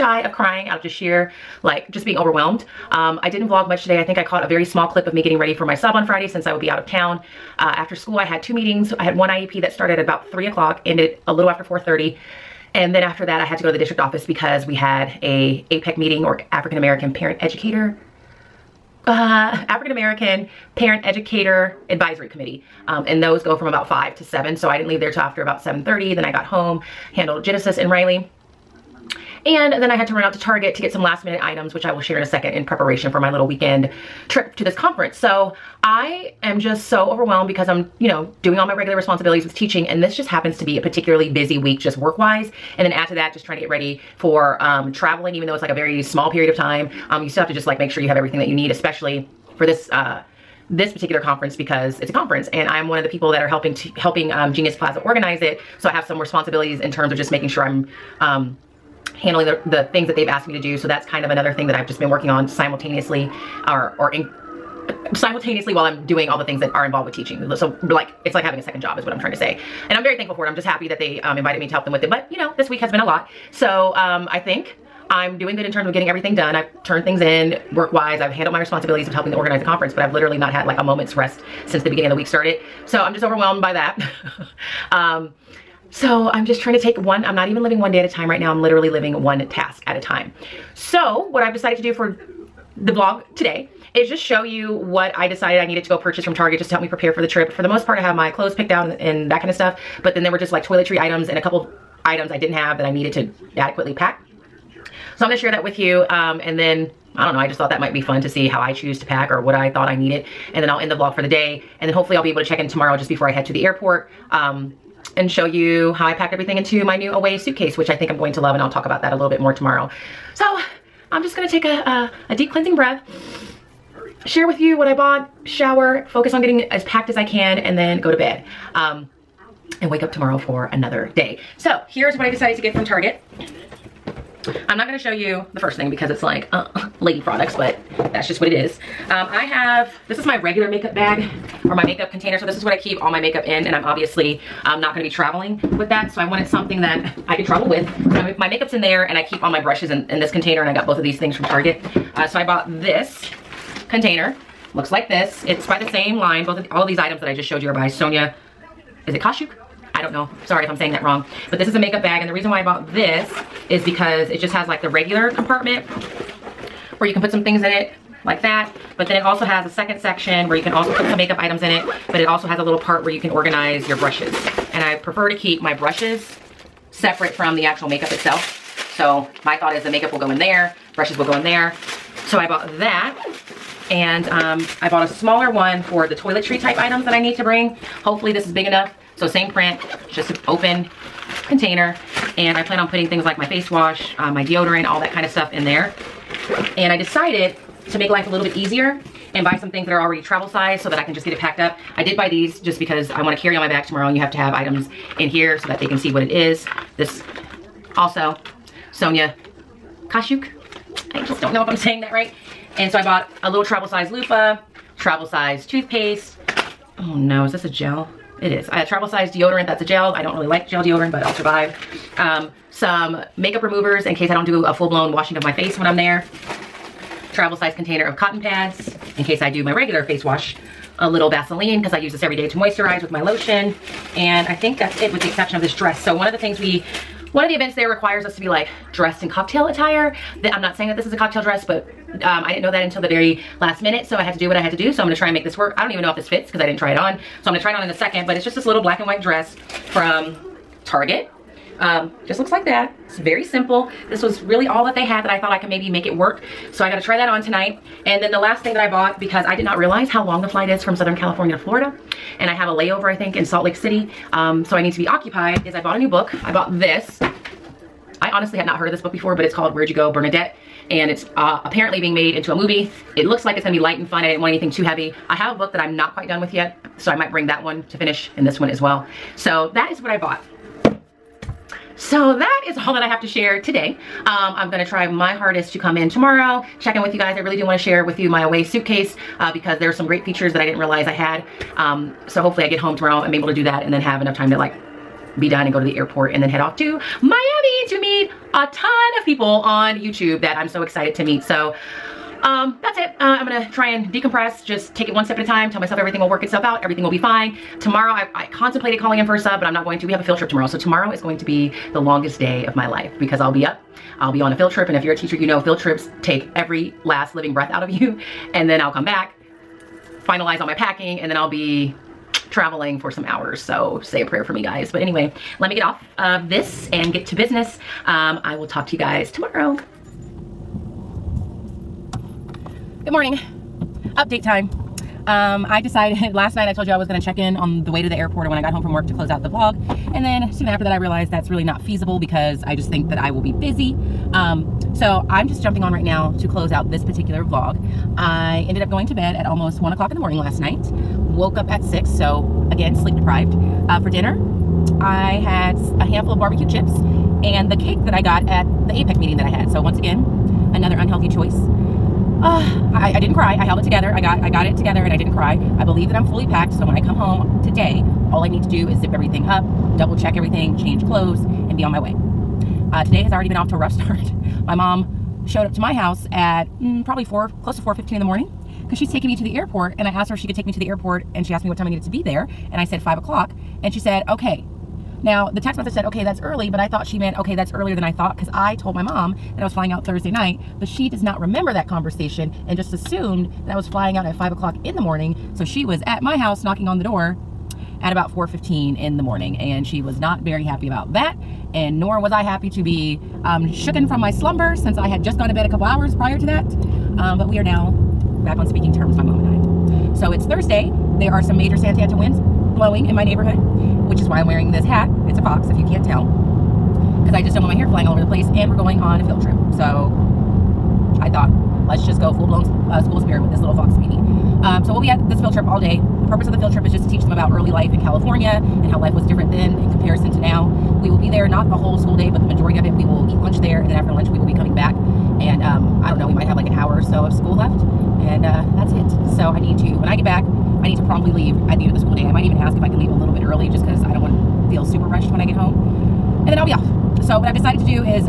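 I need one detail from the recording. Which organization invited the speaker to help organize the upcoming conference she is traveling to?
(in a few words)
Genius Plaza.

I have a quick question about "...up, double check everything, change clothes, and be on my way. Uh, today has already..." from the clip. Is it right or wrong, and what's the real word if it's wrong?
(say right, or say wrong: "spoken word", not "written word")
right.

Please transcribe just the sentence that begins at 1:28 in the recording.
I'm literally living one task at a time.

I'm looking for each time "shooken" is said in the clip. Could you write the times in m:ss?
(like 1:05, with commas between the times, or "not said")
6:43.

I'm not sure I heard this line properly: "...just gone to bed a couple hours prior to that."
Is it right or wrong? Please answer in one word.
right.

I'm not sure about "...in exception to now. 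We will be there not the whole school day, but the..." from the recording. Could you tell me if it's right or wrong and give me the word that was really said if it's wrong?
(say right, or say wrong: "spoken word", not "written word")
wrong: "comparison", not "exception".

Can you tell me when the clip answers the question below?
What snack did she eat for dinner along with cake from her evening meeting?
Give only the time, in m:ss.
5:56.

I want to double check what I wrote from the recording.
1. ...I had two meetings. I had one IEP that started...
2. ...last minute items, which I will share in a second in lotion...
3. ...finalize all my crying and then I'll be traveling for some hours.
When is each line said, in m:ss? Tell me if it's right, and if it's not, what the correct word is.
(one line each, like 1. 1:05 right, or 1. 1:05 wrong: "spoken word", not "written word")
1. 0:08 right
2. 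0:31 wrong: "preparation", not "lotion"
3. 5:20 wrong: "packing", not "crying".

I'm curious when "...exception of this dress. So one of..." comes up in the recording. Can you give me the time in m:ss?
3:55.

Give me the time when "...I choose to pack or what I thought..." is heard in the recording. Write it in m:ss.
1:48.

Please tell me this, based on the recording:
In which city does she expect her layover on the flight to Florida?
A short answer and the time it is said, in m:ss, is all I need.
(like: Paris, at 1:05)
Salt Lake City, at 4:23.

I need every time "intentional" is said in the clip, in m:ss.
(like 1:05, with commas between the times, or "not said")
not said.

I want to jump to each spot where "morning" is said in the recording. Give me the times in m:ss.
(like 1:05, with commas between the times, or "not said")
5:33, 5:50, 6:18, 6:34, 6:39.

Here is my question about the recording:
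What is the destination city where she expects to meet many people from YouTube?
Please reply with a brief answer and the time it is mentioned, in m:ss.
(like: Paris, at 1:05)
Miami, at 4:57.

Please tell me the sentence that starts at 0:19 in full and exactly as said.
Uh, African American Parent Educator Advisory Committee.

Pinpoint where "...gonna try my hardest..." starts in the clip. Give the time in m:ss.
4:44.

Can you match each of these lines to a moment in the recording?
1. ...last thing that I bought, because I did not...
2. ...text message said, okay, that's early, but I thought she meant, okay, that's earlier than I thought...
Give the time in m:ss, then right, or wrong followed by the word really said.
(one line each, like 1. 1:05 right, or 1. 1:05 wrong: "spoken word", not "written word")
1. 4:18 right
2. 6:25 right.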